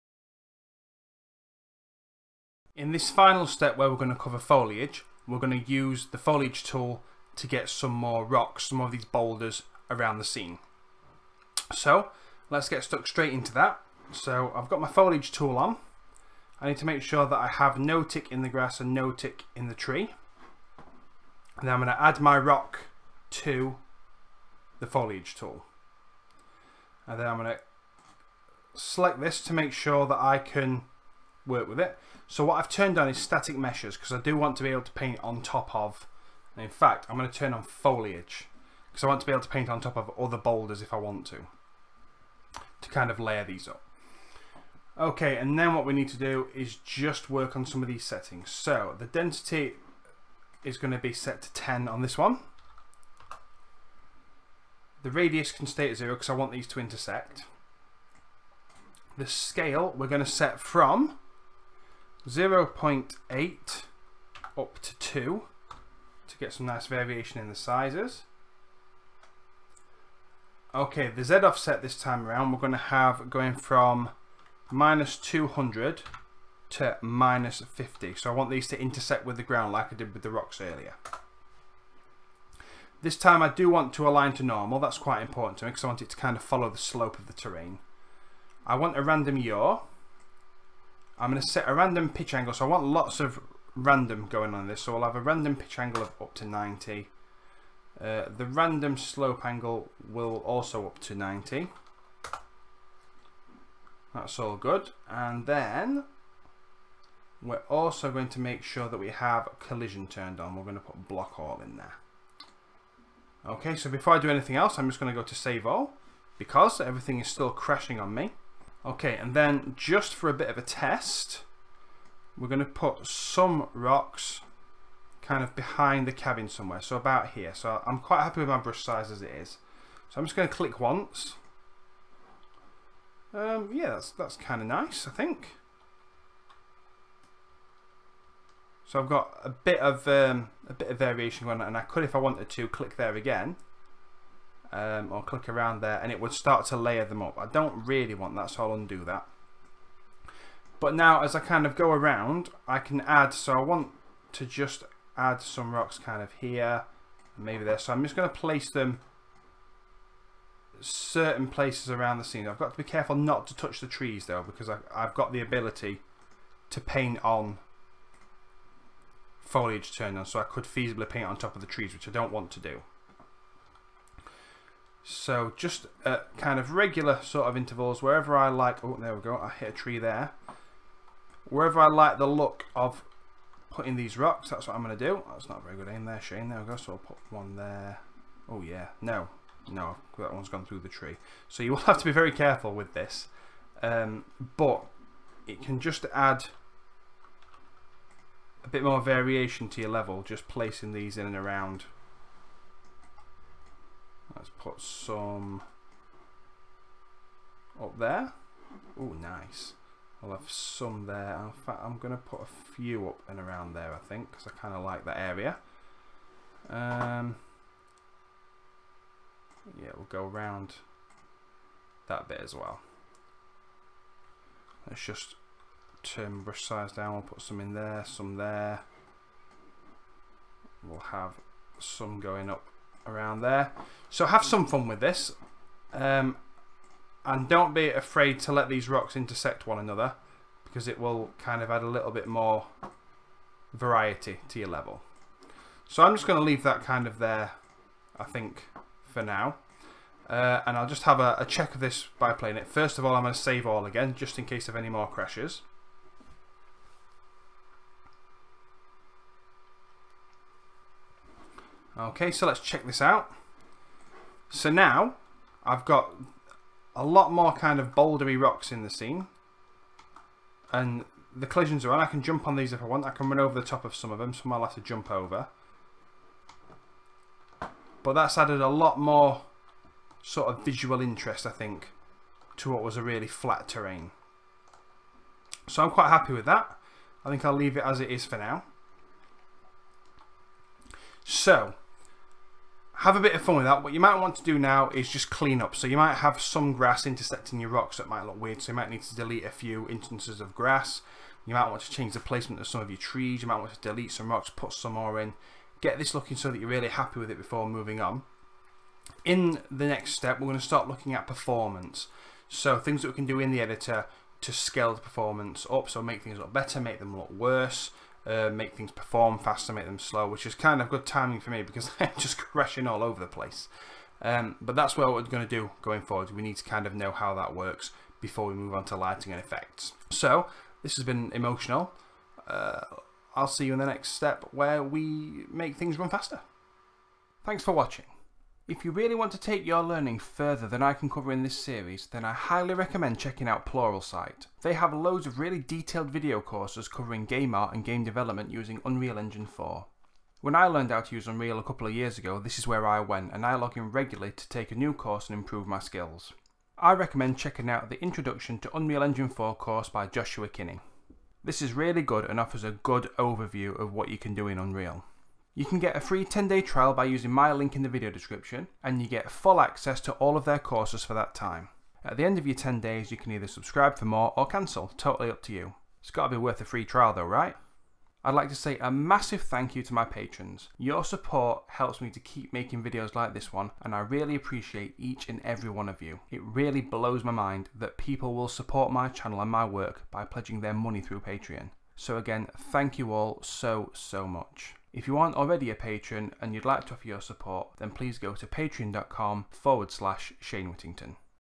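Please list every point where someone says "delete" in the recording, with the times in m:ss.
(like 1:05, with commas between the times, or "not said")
4:59, 5:03.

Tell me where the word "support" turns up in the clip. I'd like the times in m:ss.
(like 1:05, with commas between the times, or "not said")
6:21, 6:28, 6:37.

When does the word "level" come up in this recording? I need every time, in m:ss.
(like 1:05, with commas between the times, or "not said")
3:19, 4:04.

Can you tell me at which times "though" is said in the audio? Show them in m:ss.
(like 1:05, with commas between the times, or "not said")
2:44, 6:17.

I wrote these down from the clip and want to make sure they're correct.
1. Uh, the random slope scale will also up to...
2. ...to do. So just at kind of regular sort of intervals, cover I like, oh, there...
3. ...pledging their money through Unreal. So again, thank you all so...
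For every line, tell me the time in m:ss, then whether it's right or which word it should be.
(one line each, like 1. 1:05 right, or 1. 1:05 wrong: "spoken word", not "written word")
1. 1:38 wrong: "angle", not "scale"
2. 2:52 wrong: "wherever", not "cover"
3. 6:30 wrong: "Patreon", not "Unreal".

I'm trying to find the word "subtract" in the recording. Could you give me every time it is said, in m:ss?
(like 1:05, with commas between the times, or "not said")
not said.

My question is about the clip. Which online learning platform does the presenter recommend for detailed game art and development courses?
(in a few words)
Pluralsight.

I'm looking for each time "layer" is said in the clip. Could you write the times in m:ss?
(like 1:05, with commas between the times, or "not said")
0:43, 2:26.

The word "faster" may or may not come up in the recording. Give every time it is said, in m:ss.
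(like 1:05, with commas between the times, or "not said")
5:19, 5:36.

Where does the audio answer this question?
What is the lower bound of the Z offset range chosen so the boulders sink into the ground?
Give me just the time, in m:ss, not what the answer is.
1:14.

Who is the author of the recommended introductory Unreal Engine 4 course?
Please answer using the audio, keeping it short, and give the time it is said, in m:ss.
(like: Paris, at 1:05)
Joshua Kinney, at 6:00.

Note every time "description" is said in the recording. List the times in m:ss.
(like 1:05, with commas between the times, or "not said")
6:08.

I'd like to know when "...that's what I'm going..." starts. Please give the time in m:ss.
3:04.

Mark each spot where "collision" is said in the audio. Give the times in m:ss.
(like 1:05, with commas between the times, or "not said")
1:49, 4:31.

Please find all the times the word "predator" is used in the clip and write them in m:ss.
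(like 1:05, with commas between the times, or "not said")
not said.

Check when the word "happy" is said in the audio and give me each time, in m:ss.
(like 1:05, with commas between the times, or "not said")
2:08, 4:46, 5:06.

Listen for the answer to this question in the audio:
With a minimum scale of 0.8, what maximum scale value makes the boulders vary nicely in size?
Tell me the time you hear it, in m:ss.
1:04.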